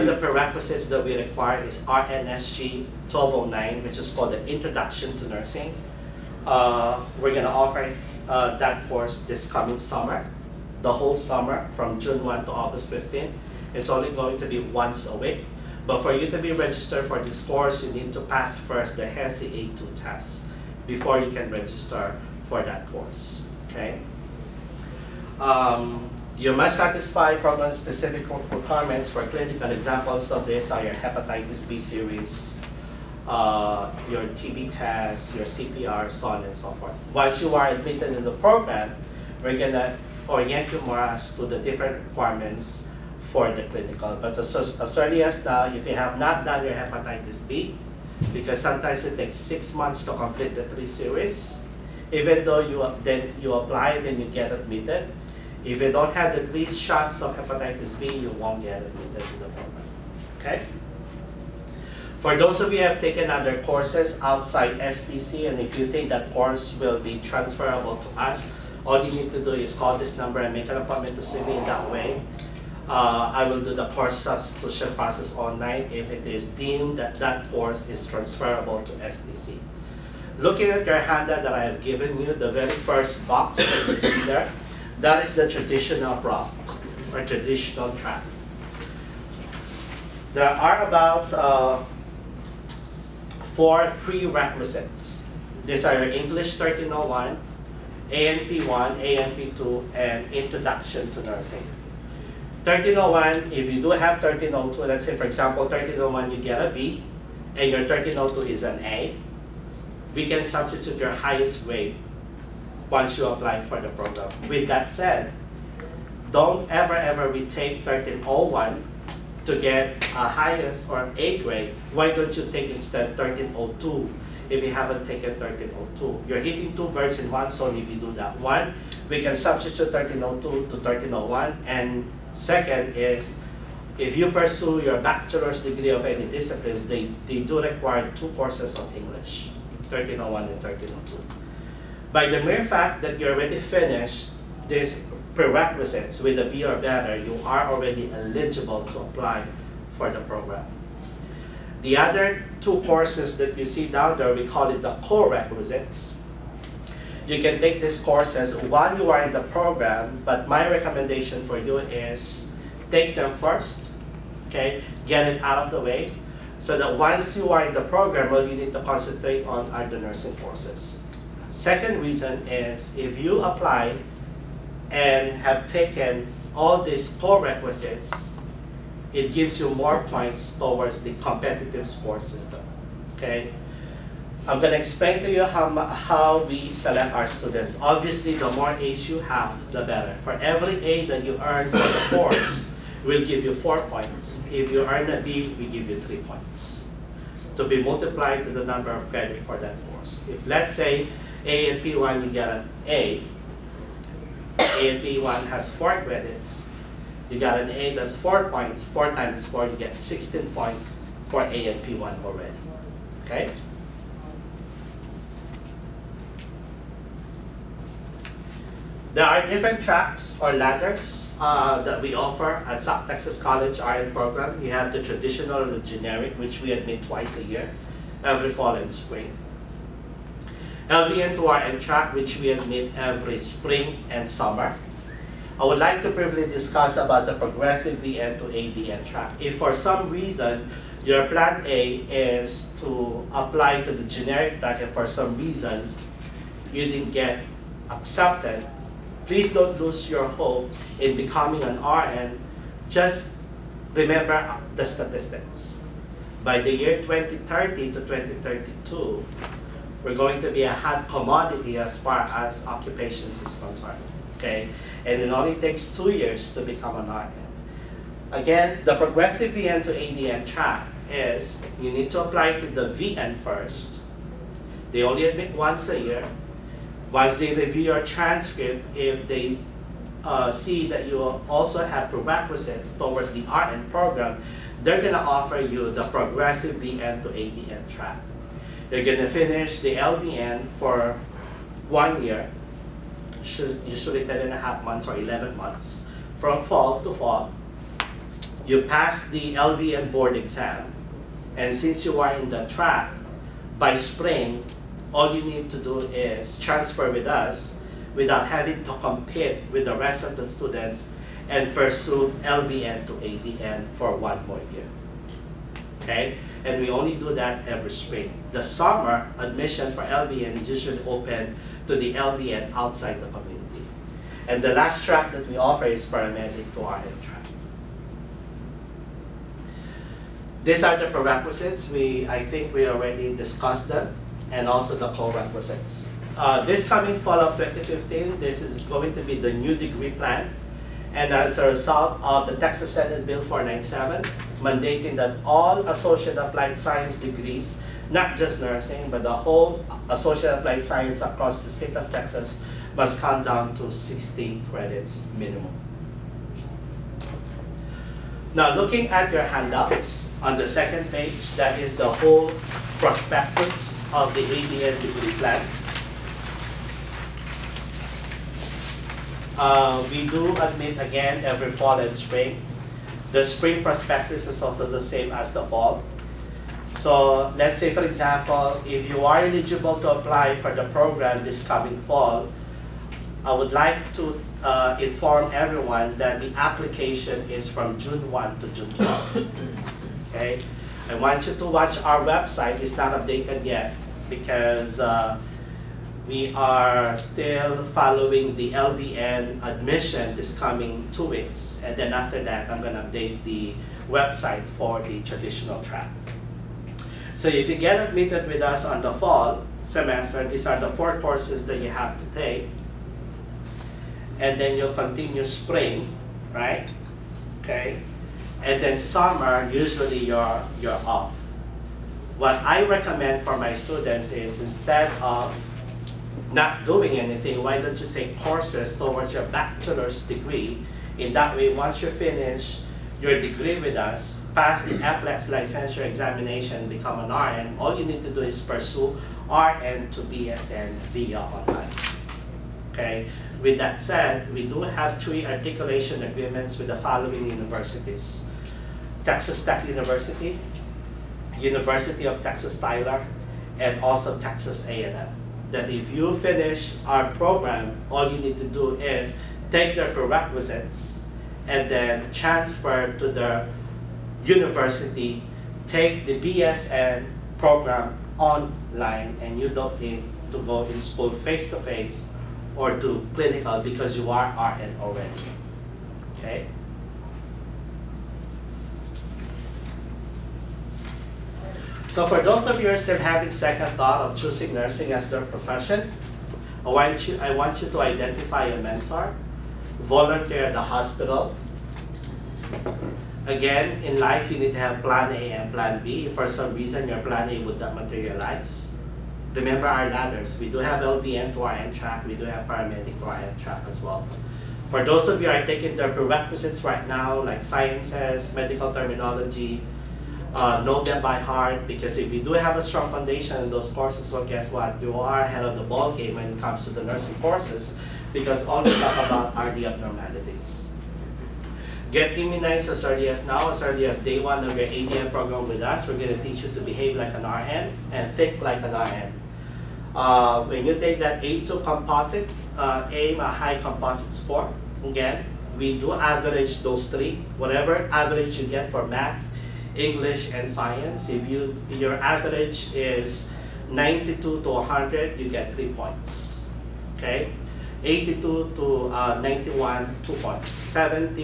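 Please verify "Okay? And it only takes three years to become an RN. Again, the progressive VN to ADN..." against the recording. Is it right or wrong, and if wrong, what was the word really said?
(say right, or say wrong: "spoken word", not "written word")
wrong: "two", not "three".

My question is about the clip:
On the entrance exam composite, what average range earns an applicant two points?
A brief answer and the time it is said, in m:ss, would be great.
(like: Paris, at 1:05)
82 to 91, at 9:08.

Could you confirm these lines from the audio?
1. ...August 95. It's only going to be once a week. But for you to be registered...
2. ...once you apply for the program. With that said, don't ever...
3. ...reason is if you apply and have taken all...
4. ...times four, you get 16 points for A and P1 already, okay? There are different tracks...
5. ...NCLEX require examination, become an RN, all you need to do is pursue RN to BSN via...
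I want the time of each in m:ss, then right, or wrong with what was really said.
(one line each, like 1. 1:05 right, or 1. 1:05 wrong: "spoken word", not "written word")
1. 0:12 wrong: "15", not "95"
2. 1:52 right
3. 2:52 right
4. 3:29 right
5. 7:14 wrong: "licensure", not "require".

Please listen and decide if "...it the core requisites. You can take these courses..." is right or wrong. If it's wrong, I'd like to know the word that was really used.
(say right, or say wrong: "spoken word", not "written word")
right.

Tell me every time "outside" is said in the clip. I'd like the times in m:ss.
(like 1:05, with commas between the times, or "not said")
1:04, 5:22.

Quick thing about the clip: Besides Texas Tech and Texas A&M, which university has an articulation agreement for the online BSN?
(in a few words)
University of Texas Tyler.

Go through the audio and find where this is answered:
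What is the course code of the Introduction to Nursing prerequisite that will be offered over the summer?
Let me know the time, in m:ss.
0:01.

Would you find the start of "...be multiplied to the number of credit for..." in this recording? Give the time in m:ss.
3:17.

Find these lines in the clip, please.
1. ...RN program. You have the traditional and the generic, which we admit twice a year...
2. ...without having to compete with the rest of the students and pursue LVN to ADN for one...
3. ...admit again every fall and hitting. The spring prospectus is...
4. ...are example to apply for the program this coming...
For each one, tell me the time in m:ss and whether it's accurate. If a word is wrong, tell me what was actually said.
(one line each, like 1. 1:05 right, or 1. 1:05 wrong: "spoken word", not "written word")
1. 3:43 right
2. 5:08 right
3. 6:10 wrong: "spring", not "hitting"
4. 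6:19 wrong: "eligible", not "example".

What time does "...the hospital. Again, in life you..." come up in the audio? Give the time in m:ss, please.
8:10.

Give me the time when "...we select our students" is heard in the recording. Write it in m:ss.
3:06.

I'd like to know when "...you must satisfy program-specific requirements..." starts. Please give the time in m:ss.
0:26.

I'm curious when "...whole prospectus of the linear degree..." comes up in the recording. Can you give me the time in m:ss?
6:02.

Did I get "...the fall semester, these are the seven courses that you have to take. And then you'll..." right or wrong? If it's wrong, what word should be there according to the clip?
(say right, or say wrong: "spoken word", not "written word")
wrong: "four", not "seven".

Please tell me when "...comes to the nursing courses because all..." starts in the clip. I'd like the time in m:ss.
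8:36.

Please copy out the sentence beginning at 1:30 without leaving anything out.
There are about uh, four prerequisites.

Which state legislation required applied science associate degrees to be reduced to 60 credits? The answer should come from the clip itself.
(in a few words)
Texas Senate Bill 497.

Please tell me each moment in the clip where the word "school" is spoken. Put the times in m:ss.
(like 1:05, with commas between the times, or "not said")
7:51.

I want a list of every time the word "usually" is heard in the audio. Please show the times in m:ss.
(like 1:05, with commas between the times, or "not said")
4:53, 5:20, 6:59.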